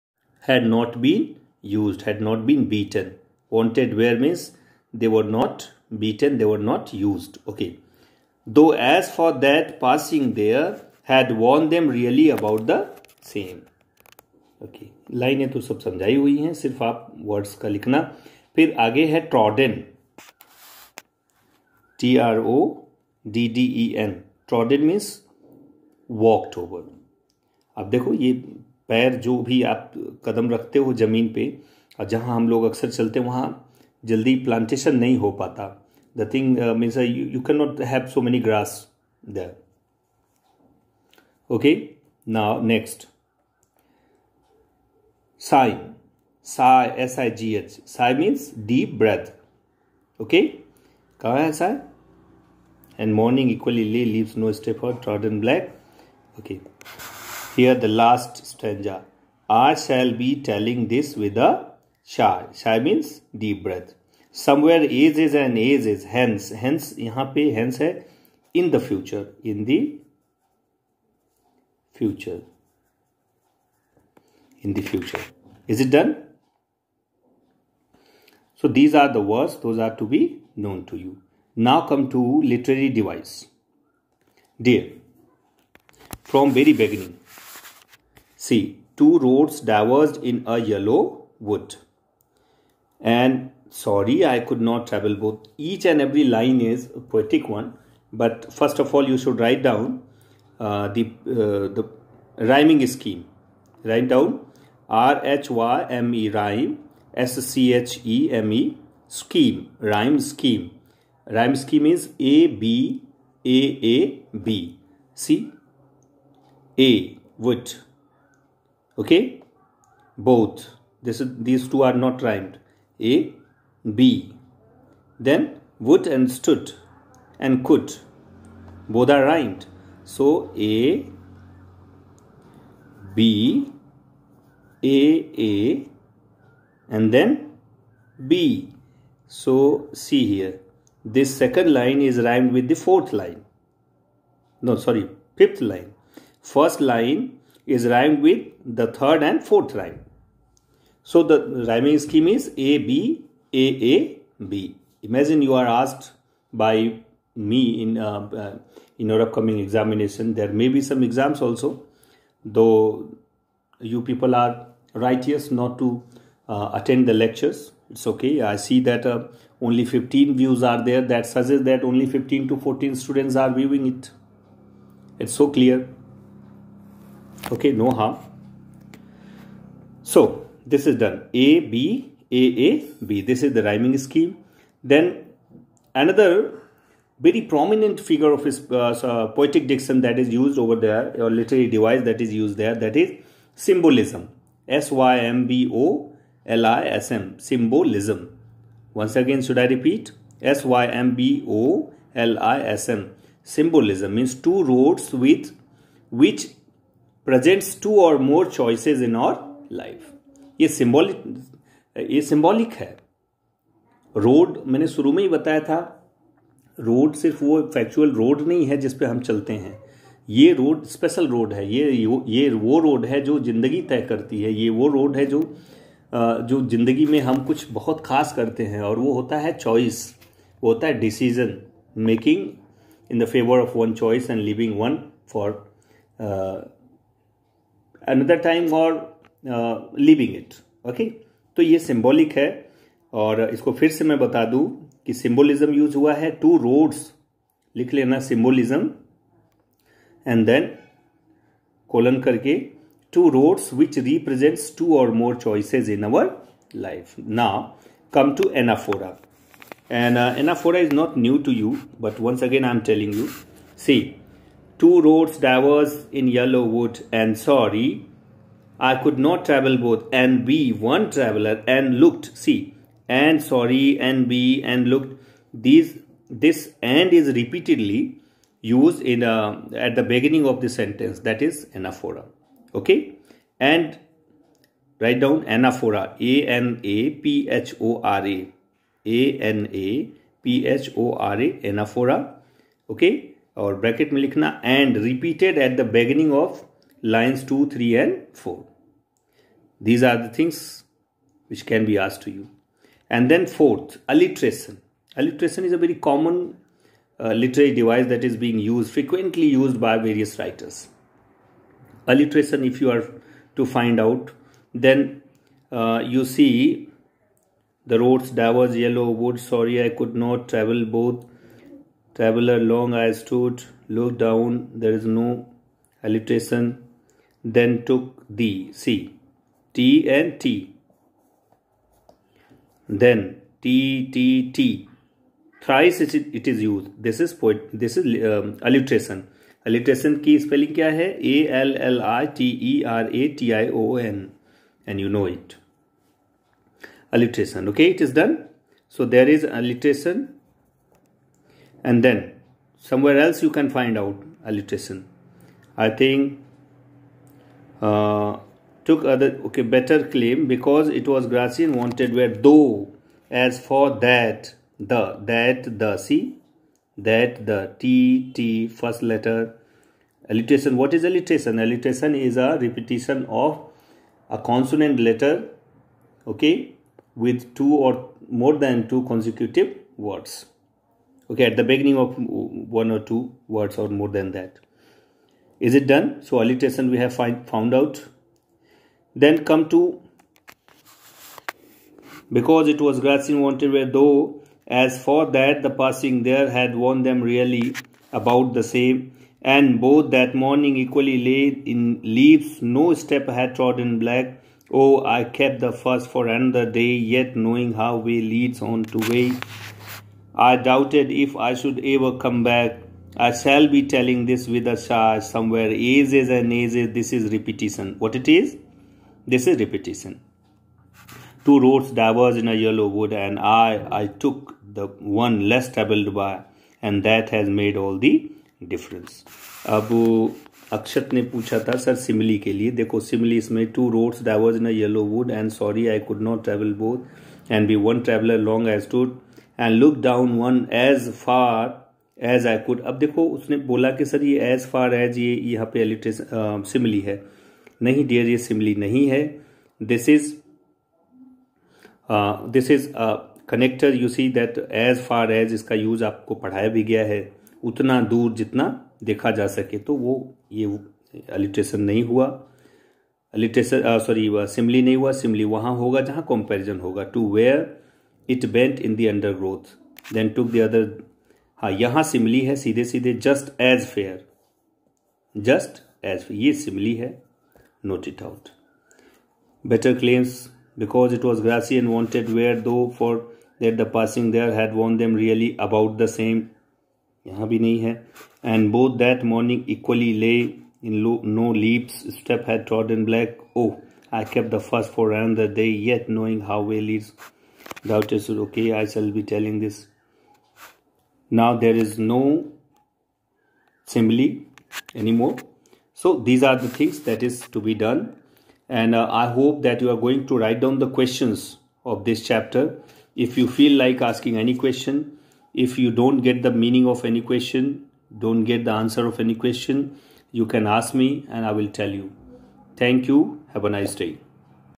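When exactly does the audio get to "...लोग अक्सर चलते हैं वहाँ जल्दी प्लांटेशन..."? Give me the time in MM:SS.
00:32.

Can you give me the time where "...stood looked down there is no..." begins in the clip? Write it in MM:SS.
05:23.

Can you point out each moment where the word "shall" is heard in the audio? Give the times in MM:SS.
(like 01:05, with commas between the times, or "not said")
00:59, 06:53, 08:18.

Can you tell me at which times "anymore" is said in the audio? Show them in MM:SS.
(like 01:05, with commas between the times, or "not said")
08:24.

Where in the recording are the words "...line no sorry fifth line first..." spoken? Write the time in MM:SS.
02:23.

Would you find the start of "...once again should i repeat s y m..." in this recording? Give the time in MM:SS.
03:18.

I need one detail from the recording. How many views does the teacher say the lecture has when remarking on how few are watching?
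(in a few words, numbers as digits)
15.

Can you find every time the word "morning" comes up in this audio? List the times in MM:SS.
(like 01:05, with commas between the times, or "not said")
06:40, 08:09.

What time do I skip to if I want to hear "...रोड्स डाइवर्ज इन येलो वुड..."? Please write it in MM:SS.
07:13.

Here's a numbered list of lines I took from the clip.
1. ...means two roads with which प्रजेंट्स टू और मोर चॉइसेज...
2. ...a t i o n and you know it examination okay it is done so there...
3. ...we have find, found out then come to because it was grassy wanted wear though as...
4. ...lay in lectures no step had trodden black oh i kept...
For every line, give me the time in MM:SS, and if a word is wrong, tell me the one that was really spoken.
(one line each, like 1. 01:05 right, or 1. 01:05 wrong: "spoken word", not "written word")
1. 03:24 right
2. 05:43 wrong: "alliteration", not "examination"
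3. 06:26 right
4. 06:41 wrong: "leaves", not "lectures".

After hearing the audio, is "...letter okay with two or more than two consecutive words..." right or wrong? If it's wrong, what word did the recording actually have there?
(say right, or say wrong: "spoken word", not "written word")
right.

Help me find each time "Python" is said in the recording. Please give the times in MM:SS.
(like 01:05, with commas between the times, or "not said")
not said.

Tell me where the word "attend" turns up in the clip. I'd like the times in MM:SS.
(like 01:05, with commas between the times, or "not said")
02:46.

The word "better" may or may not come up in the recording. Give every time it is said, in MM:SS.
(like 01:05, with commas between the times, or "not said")
05:59.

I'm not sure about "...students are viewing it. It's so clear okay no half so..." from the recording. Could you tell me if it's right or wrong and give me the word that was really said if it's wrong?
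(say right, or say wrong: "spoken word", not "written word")
right.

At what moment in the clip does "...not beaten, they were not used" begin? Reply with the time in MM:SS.
00:05.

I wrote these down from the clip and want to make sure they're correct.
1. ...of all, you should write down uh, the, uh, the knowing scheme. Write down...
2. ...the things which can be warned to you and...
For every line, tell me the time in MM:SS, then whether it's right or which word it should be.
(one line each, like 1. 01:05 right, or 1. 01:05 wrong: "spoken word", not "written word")
1. 01:38 wrong: "rhyming", not "knowing"
2. 05:00 wrong: "asked", not "warned".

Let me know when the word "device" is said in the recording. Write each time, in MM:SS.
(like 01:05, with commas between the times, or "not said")
01:23, 03:11, 05:07.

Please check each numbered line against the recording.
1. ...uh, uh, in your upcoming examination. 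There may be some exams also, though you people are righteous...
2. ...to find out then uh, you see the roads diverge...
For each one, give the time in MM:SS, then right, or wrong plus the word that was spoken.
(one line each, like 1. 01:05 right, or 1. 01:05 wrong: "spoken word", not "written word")
1. 02:37 right
2. 05:13 right.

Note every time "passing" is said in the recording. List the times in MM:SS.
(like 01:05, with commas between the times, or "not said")
00:09, 06:35, 08:03.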